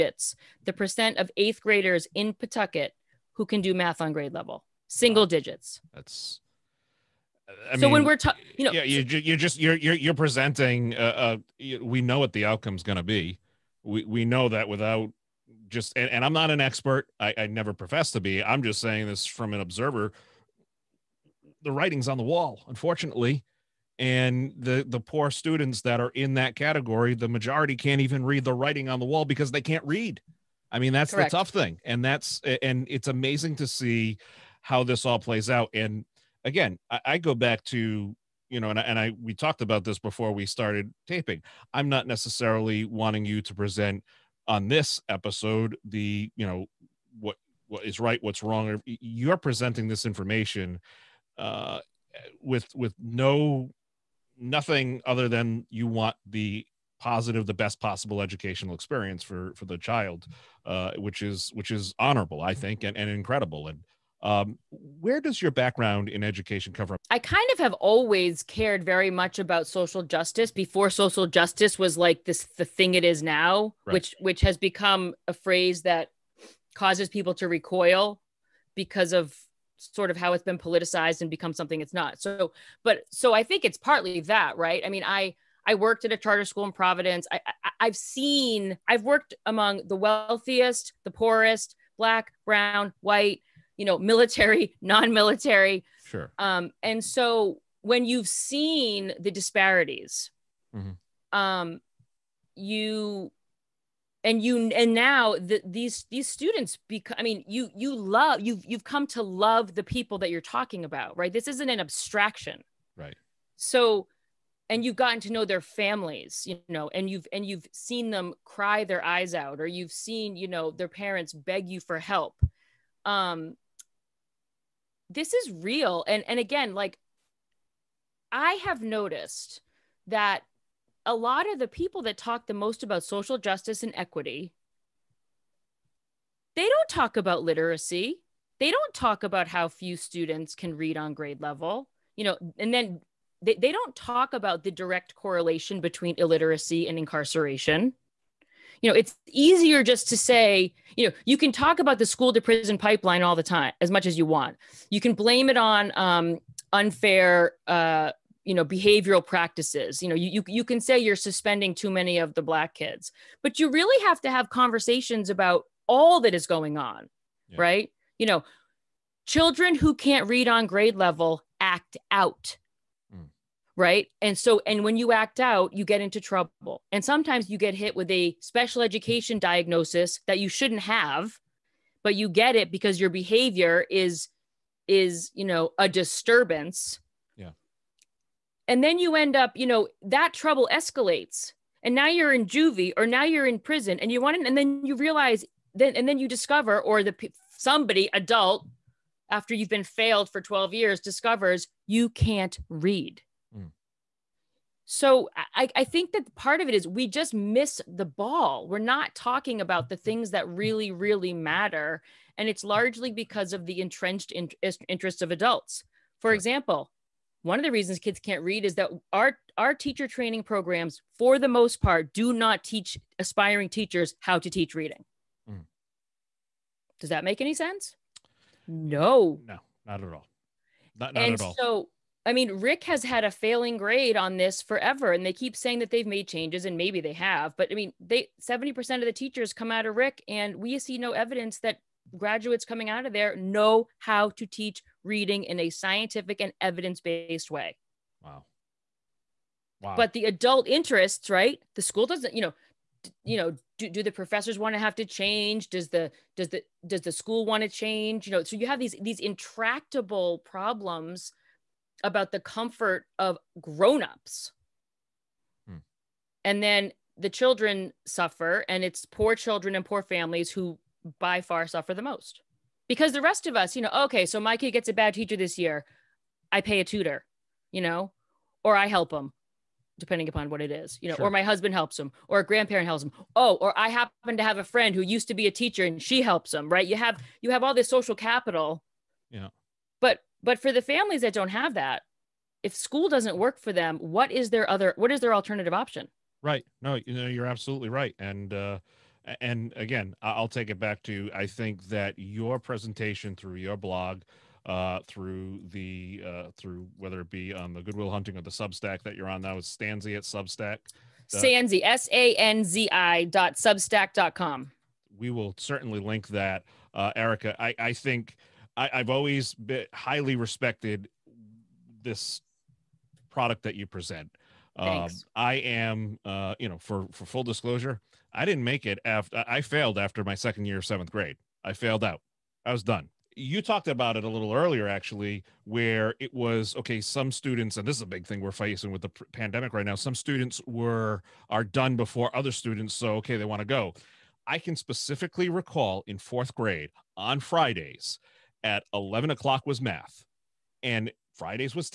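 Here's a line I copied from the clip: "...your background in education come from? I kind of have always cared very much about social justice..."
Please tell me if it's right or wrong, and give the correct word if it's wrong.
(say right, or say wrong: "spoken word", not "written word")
right.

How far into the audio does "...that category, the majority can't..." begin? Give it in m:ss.
0:26.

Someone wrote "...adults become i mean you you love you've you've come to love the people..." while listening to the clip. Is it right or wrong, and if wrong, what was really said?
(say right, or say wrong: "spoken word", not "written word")
wrong: "students", not "adults".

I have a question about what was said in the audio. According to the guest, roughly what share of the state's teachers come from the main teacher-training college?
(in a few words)
70%.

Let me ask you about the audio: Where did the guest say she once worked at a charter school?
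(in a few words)
Providence.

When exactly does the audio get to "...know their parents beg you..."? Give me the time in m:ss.
2:00.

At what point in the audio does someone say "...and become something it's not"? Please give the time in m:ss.
1:21.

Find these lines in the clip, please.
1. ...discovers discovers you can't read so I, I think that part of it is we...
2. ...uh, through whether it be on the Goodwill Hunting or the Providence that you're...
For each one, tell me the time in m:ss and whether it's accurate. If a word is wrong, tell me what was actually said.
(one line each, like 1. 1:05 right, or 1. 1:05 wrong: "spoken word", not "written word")
1. 3:20 wrong: "years", not "discovers"
2. 5:06 wrong: "Substack", not "Providence".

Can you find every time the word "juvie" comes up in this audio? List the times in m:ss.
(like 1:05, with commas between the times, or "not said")
3:12.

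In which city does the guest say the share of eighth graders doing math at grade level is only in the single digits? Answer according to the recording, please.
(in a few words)
Pawtucket.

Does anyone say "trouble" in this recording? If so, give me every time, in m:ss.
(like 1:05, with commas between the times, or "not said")
2:56, 3:10.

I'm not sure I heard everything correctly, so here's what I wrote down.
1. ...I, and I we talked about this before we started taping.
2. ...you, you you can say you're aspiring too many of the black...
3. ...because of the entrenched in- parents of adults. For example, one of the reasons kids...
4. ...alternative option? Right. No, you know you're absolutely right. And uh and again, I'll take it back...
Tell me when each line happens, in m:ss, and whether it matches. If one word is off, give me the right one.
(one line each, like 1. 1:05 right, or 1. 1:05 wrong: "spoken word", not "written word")
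1. 0:38 right
2. 2:40 wrong: "suspending", not "aspiring"
3. 3:33 wrong: "interests", not "parents"
4. 4:55 right.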